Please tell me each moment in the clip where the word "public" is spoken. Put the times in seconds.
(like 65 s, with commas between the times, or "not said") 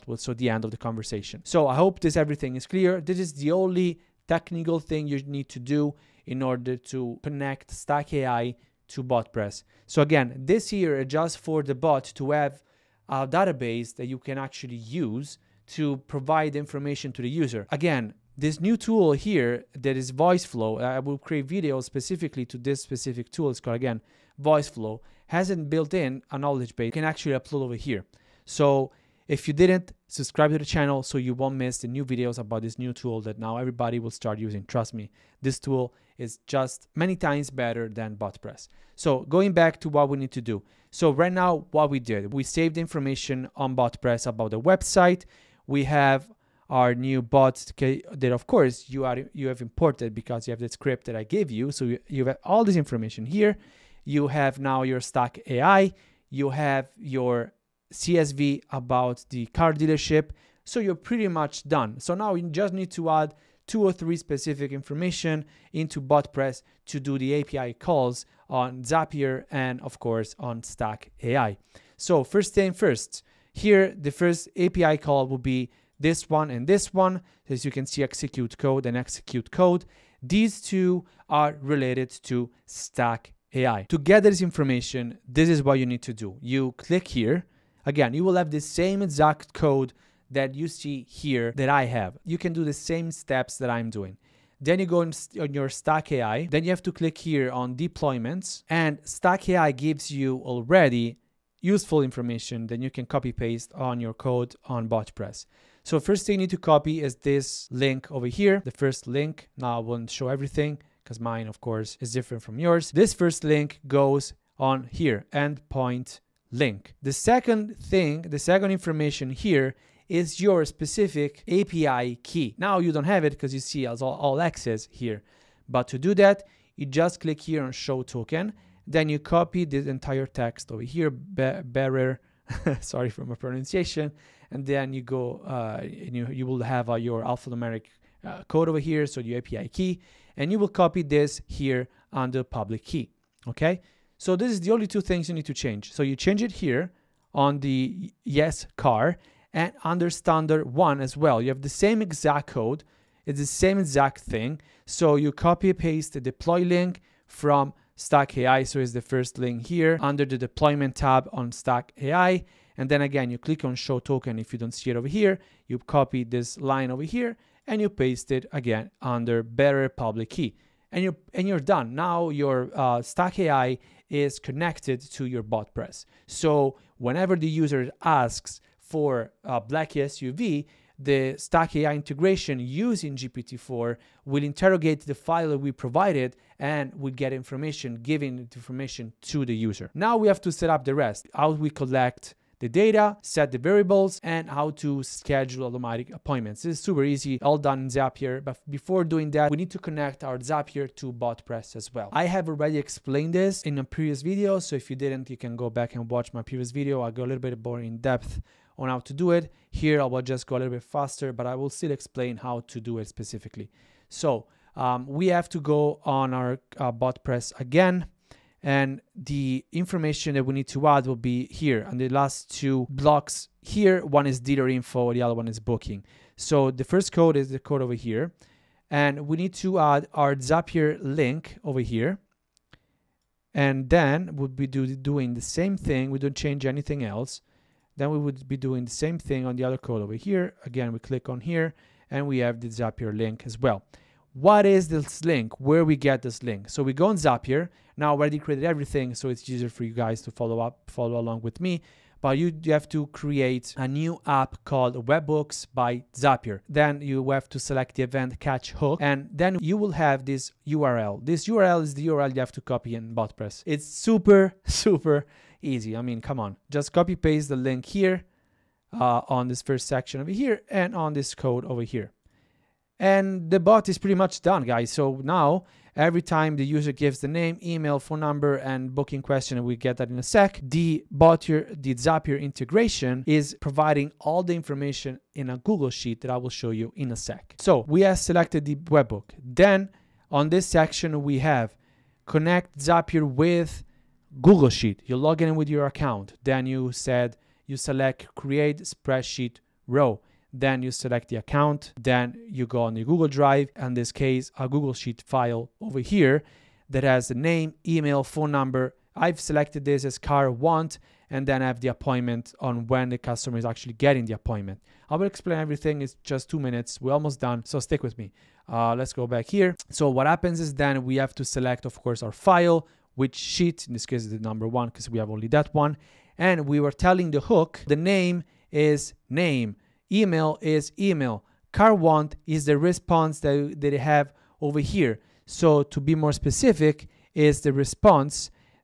142 s, 169 s.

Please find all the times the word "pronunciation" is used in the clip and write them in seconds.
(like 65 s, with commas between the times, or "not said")
133 s.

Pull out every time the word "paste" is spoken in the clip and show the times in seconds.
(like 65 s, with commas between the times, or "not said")
103 s, 155 s, 167 s, 267 s.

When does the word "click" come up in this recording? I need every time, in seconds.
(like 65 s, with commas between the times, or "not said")
86 s, 96 s, 127 s, 163 s, 240 s.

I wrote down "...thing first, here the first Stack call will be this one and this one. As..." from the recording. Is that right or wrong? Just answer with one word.
wrong.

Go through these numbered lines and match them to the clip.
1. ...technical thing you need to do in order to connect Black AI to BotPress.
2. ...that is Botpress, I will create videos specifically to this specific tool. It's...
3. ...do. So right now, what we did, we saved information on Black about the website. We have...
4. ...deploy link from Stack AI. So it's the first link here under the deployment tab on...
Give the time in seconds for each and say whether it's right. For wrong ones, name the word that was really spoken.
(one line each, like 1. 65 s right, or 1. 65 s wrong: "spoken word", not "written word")
1. 4 s wrong: "Stack", not "Black"
2. 19 s wrong: "VoiceFlow", not "Botpress"
3. 40 s wrong: "BotPress", not "Black"
4. 156 s right.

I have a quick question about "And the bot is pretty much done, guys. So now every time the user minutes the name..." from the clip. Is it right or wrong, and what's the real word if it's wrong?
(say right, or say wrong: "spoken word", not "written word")
wrong: "gives", not "minutes".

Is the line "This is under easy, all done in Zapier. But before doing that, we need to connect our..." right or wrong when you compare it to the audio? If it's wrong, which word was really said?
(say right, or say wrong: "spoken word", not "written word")
wrong: "super", not "under".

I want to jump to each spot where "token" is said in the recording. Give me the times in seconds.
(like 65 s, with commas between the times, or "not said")
128 s, 163 s.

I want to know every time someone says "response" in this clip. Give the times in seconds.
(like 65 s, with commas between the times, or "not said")
332 s, 337 s.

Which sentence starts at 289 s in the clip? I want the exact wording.
Then on this section, we have connect Zapier with Google Sheet.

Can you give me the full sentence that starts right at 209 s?
Here, I will just go a little bit faster, but I will still explain how to do it specifically.